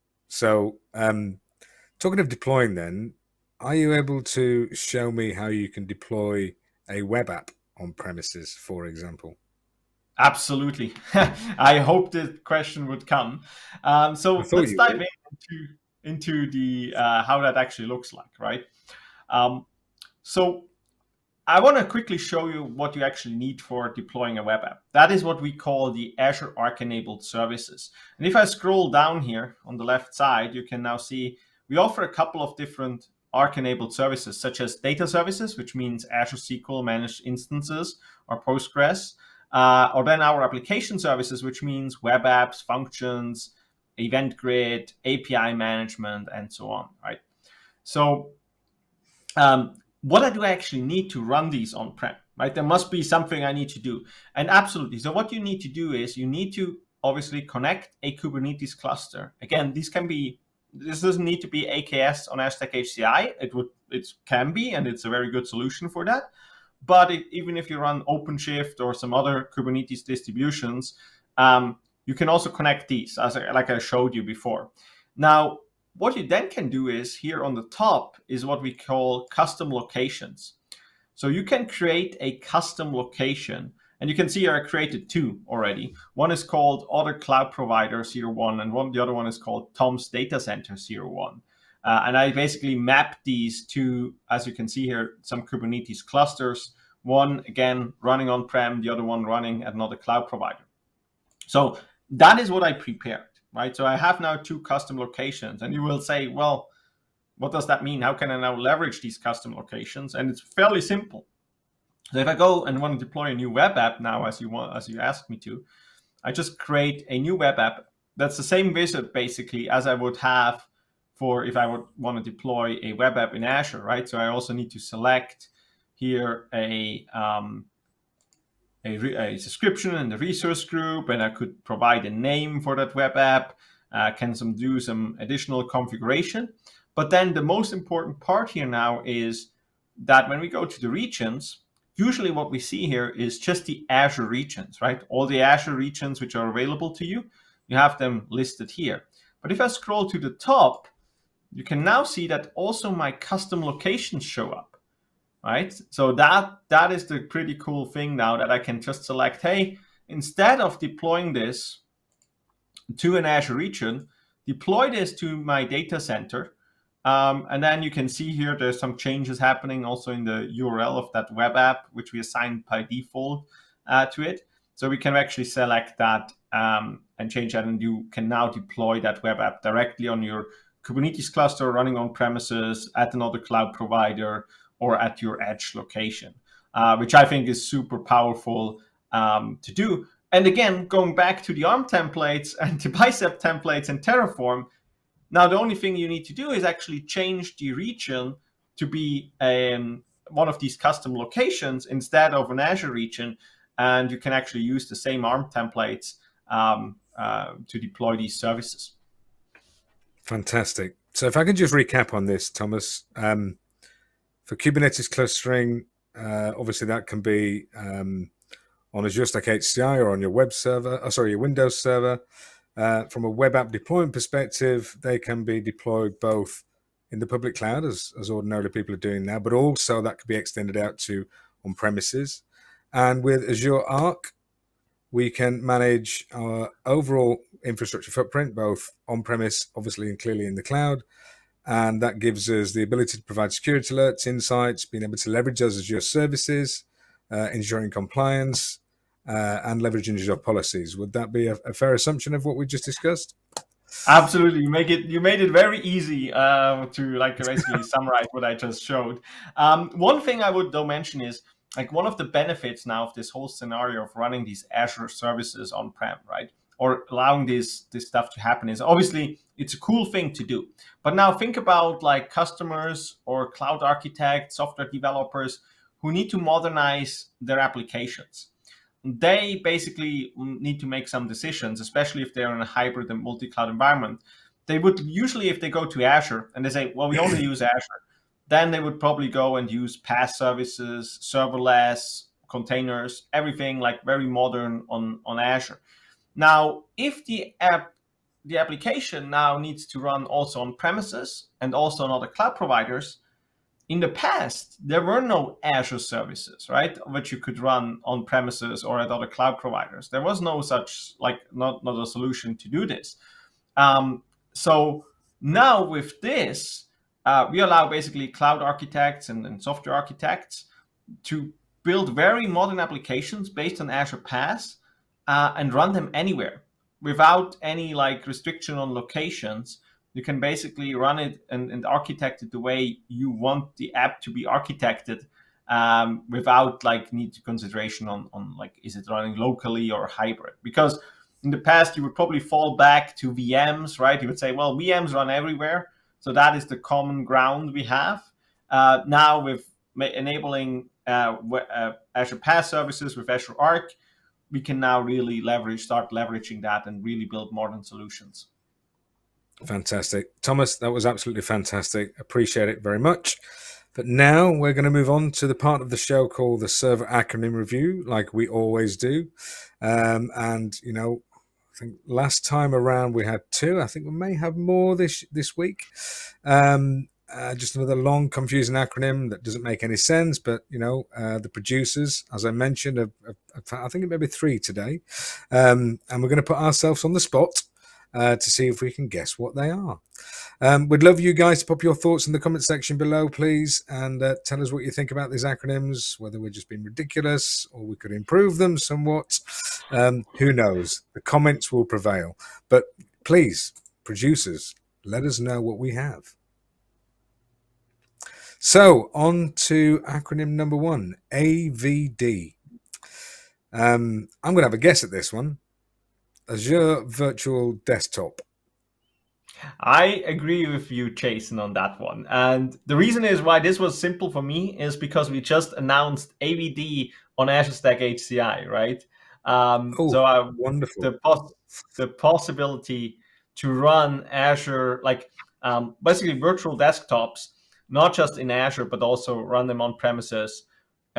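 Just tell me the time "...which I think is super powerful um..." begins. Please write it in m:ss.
3:06.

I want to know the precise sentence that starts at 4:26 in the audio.
Or allowing this this stuff to happen is obviously it's a cool thing to do.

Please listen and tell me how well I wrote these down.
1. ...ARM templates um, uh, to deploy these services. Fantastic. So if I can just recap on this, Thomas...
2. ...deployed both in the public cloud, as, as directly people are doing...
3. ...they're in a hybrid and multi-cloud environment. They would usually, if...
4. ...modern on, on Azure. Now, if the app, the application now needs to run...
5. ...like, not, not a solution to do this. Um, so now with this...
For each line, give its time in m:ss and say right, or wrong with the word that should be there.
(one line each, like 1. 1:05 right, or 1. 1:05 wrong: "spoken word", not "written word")
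1. 3:25 right
2. 3:45 wrong: "ordinarily", not "directly"
3. 4:42 right
4. 4:54 right
5. 5:11 right.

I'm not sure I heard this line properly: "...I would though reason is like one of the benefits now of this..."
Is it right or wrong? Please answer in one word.
wrong.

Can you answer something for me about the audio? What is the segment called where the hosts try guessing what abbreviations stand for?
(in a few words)
server acronym review.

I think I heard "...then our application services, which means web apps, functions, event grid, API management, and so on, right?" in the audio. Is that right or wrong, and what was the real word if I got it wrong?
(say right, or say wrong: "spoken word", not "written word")
right.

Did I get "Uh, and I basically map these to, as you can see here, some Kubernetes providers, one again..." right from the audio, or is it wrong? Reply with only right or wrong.
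wrong.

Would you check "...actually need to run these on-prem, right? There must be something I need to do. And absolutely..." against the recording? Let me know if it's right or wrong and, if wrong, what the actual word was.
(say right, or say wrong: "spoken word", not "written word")
right.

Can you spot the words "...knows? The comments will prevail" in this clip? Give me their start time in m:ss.
6:40.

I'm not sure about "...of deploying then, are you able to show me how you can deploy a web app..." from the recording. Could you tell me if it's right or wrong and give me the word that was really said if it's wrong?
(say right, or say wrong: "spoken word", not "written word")
right.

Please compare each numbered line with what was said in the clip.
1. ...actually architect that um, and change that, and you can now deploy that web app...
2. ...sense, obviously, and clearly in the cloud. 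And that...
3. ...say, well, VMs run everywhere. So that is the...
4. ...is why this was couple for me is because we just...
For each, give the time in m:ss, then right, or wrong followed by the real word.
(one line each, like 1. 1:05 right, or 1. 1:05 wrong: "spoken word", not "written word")
1. 2:55 wrong: "select", not "architect"
2. 3:59 wrong: "premise", not "sense"
3. 5:44 right
4. 7:03 wrong: "simple", not "couple".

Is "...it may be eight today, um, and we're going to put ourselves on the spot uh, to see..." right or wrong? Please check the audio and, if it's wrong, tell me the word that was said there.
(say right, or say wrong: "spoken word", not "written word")
wrong: "three", not "eight".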